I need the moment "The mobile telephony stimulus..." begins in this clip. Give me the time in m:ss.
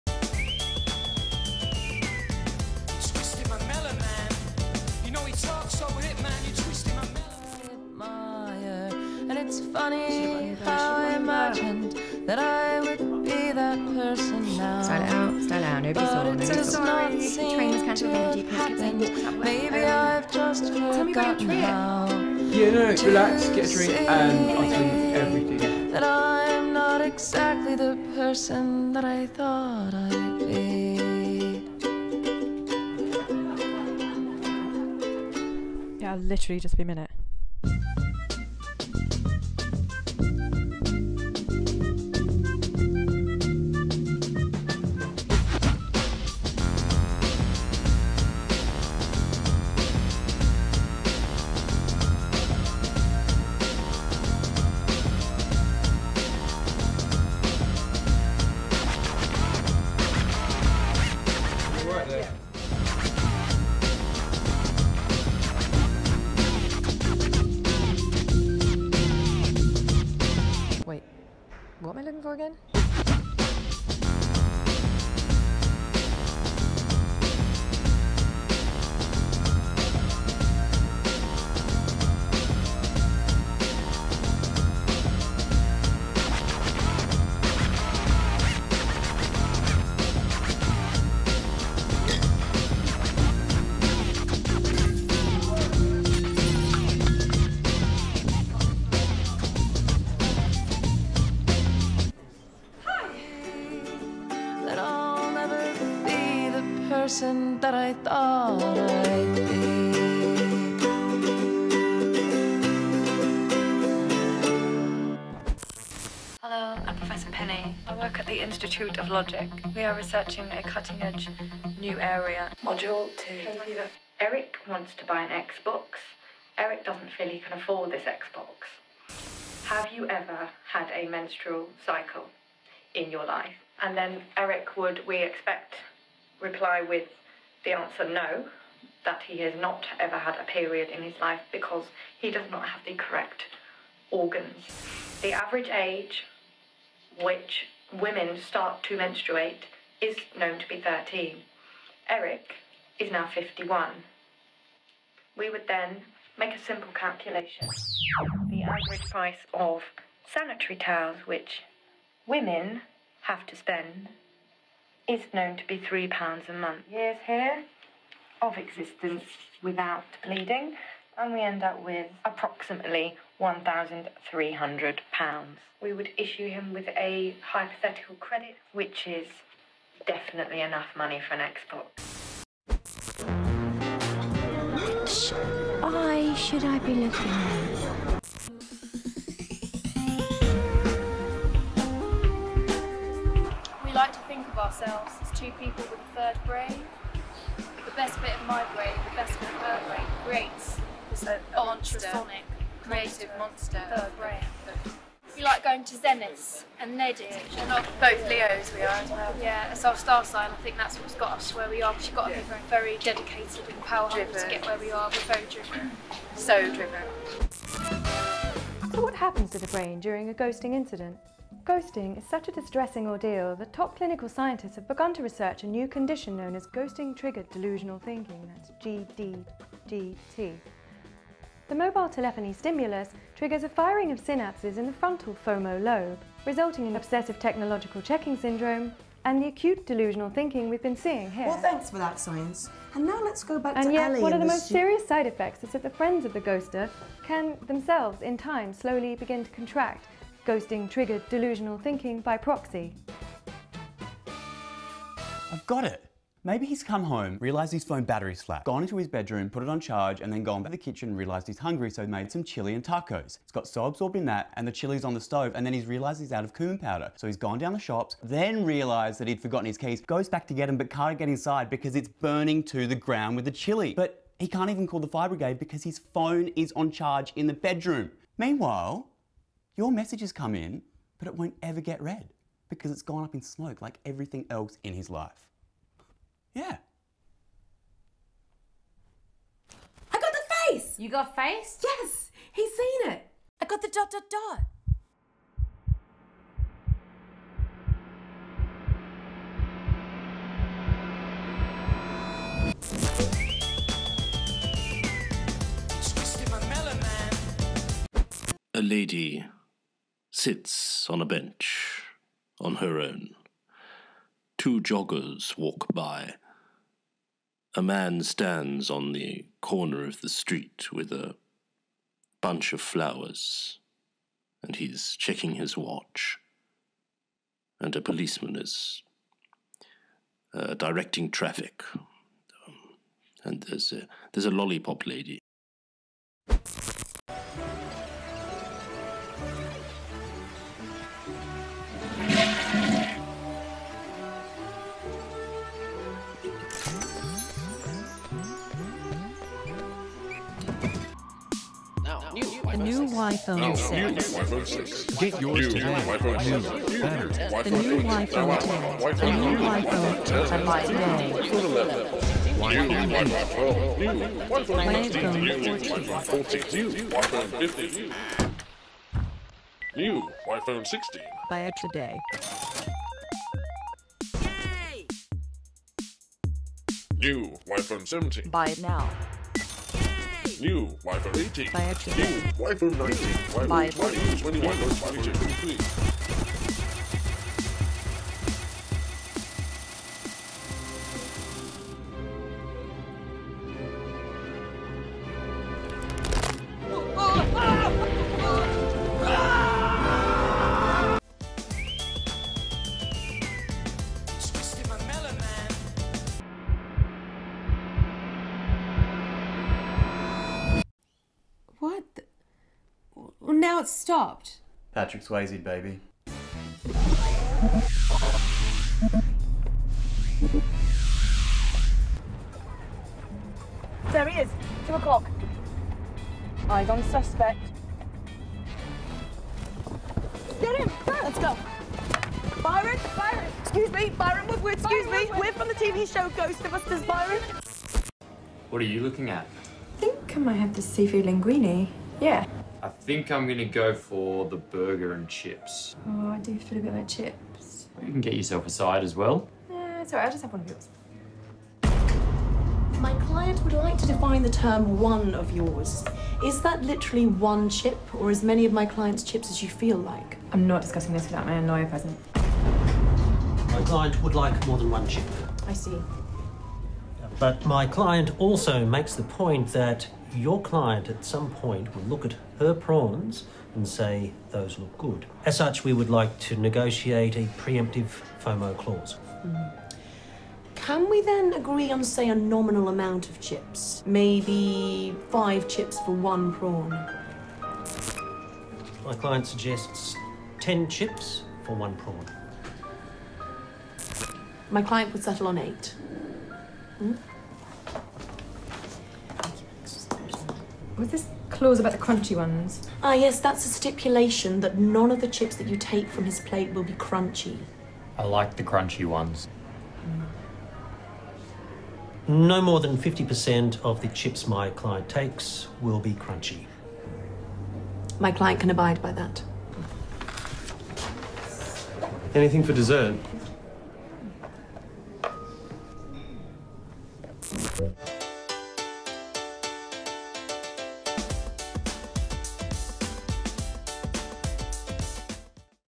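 3:51.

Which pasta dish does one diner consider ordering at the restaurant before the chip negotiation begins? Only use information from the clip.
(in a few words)
Seafood linguine.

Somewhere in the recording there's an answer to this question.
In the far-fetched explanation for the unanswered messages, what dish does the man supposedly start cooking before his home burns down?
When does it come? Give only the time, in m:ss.
4:22.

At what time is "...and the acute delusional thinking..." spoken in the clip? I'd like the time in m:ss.
3:59.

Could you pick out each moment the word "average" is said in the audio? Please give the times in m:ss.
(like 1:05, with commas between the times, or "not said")
2:25, 2:38.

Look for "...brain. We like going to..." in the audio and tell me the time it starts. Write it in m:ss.
3:24.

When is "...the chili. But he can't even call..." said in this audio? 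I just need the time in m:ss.
4:33.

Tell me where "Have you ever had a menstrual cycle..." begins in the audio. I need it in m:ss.
2:09.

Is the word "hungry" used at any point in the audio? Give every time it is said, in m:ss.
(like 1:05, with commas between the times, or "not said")
3:34, 4:21.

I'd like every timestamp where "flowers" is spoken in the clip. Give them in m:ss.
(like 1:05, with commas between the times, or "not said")
5:22.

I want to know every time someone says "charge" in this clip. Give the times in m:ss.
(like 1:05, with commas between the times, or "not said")
4:19, 4:36.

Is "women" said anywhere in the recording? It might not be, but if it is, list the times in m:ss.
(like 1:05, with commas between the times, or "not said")
2:27, 2:42.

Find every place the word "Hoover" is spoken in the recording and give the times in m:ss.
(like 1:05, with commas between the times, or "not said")
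not said.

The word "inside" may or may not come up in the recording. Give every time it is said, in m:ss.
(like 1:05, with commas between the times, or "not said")
4:31.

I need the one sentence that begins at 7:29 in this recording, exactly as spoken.
Yeah, sorry, right, I'll just have one of yours.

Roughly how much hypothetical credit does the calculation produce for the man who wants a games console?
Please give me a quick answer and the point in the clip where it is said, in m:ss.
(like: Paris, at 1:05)
£1,300, at 2:53.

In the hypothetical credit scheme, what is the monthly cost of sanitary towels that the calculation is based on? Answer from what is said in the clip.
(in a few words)
3 pounds.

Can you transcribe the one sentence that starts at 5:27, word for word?
And a policeman is uh, directing traffic.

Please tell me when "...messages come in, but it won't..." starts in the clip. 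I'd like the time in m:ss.
4:39.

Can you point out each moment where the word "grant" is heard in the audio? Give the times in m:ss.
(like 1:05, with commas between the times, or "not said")
not said.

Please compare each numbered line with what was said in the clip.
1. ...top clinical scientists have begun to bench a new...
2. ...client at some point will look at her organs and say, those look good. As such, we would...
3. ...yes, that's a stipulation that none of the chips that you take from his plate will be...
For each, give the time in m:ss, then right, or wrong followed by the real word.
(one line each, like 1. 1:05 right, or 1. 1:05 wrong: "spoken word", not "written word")
1. 3:43 wrong: "research", not "bench"
2. 7:50 wrong: "prawns", not "organs"
3. 8:23 right.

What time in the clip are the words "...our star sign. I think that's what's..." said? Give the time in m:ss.
3:29.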